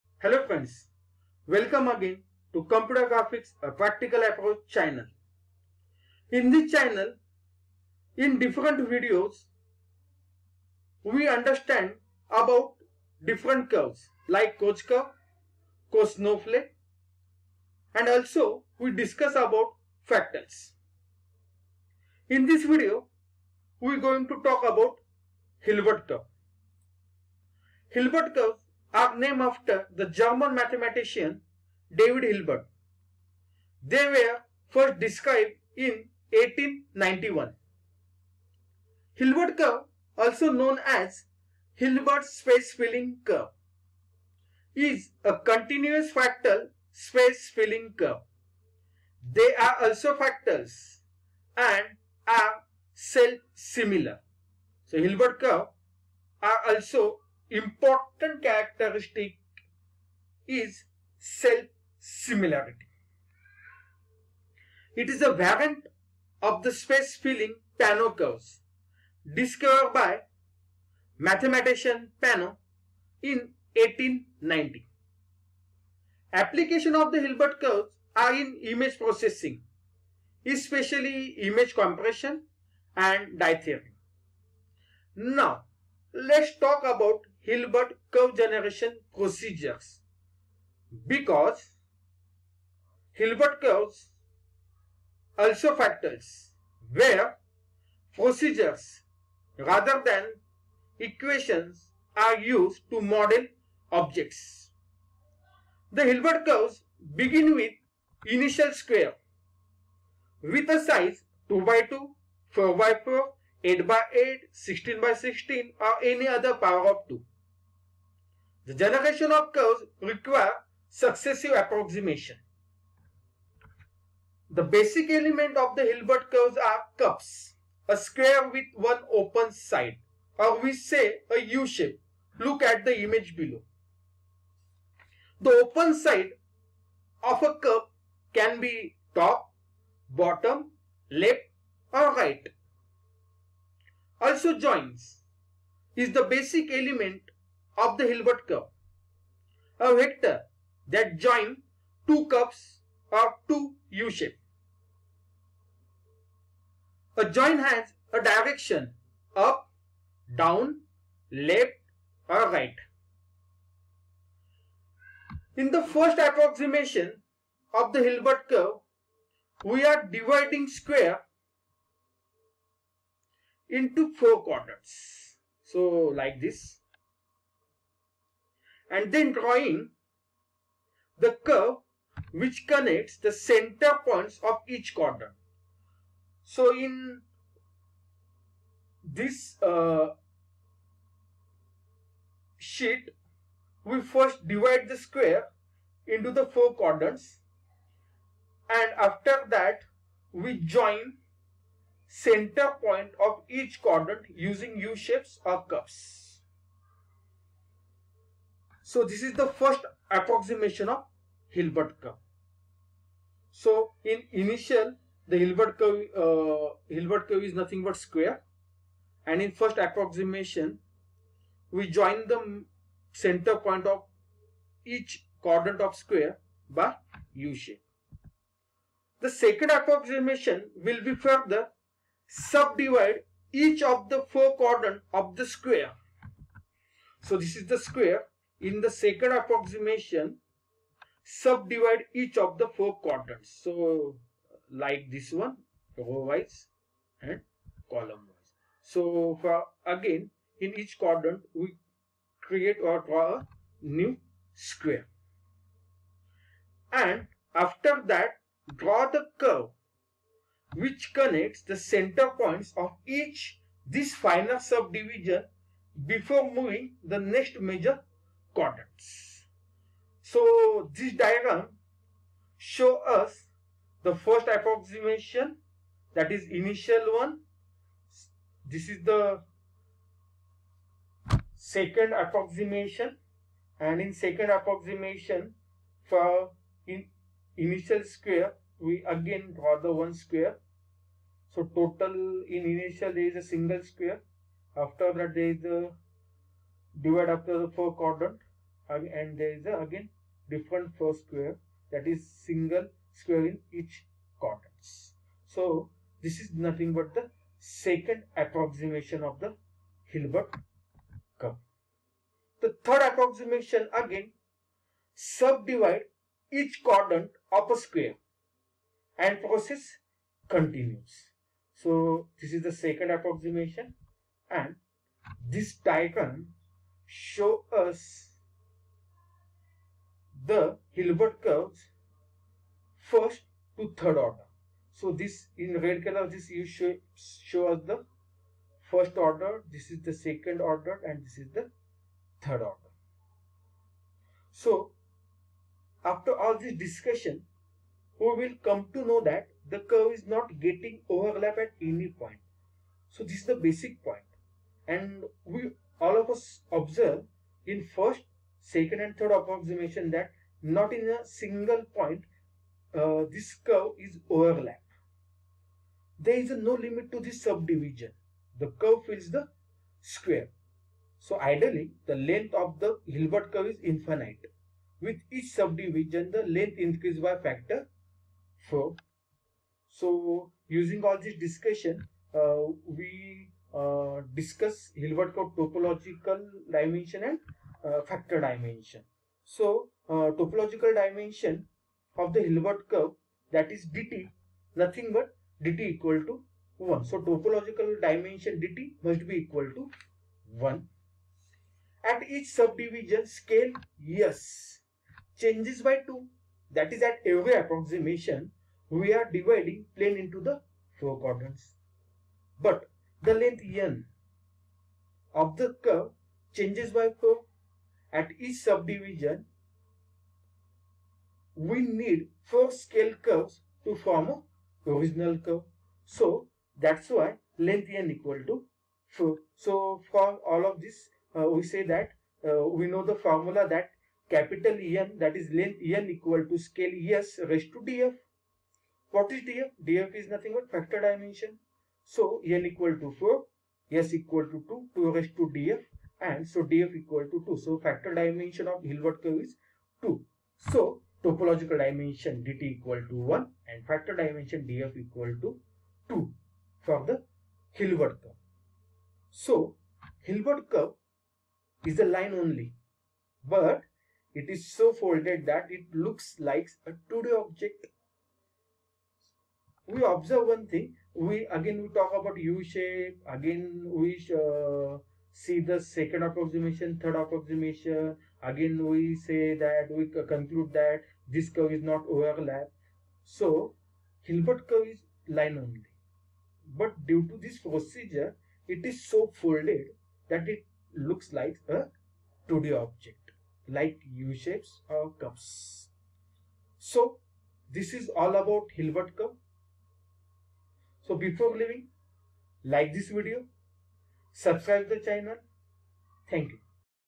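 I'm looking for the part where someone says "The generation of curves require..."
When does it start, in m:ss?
1:58.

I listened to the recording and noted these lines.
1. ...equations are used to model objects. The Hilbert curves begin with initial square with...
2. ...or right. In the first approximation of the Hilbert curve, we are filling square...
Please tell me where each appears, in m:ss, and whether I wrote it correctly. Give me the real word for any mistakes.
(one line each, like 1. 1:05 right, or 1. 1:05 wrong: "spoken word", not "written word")
1. 1:40 right
2. 2:42 wrong: "dividing", not "filling".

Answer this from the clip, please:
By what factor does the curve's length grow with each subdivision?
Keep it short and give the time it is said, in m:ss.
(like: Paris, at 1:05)
4, at 6:17.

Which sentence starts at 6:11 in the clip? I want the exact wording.
So ideally, the length of the Hilbert curve is infinite.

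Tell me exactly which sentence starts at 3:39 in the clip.
And in first approximation, we join the center point of each quadrant of square by U shape.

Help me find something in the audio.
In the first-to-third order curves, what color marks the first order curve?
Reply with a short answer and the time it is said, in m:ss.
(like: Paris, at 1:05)
red, at 5:35.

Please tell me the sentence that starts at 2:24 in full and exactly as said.
Also joins is the basic element of the Hilbert curve.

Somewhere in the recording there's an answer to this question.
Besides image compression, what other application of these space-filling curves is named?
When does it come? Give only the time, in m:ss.
1:23.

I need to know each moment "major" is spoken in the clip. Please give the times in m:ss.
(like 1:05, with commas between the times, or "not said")
4:27.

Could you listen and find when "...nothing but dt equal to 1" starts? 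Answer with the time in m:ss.
6:34.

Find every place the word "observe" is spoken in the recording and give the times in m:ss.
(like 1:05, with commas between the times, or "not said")
5:56, 7:50.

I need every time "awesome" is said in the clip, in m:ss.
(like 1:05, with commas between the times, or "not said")
not said.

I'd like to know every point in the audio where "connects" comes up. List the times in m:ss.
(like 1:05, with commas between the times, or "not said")
3:02, 4:21.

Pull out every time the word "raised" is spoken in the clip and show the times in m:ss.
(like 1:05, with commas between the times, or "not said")
7:17, 7:25.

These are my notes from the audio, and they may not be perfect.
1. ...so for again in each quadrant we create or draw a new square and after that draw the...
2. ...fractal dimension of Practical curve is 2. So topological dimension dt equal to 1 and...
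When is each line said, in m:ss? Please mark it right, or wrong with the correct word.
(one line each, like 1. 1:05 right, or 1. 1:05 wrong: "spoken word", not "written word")
1. 4:08 right
2. 7:27 wrong: "Hilbert", not "Practical".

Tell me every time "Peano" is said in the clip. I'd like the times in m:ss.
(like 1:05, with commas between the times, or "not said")
1:07, 1:12.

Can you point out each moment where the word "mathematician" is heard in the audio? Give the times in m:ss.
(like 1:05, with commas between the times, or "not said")
0:30, 1:11.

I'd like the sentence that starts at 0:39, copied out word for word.
Hilbert curve, also known as Hilbert space filling curve, is a continuous fractal space filling curve.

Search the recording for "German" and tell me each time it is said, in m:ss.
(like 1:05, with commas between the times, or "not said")
0:30.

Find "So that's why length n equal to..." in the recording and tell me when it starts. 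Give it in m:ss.
7:06.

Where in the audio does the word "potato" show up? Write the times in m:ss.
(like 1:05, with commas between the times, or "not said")
not said.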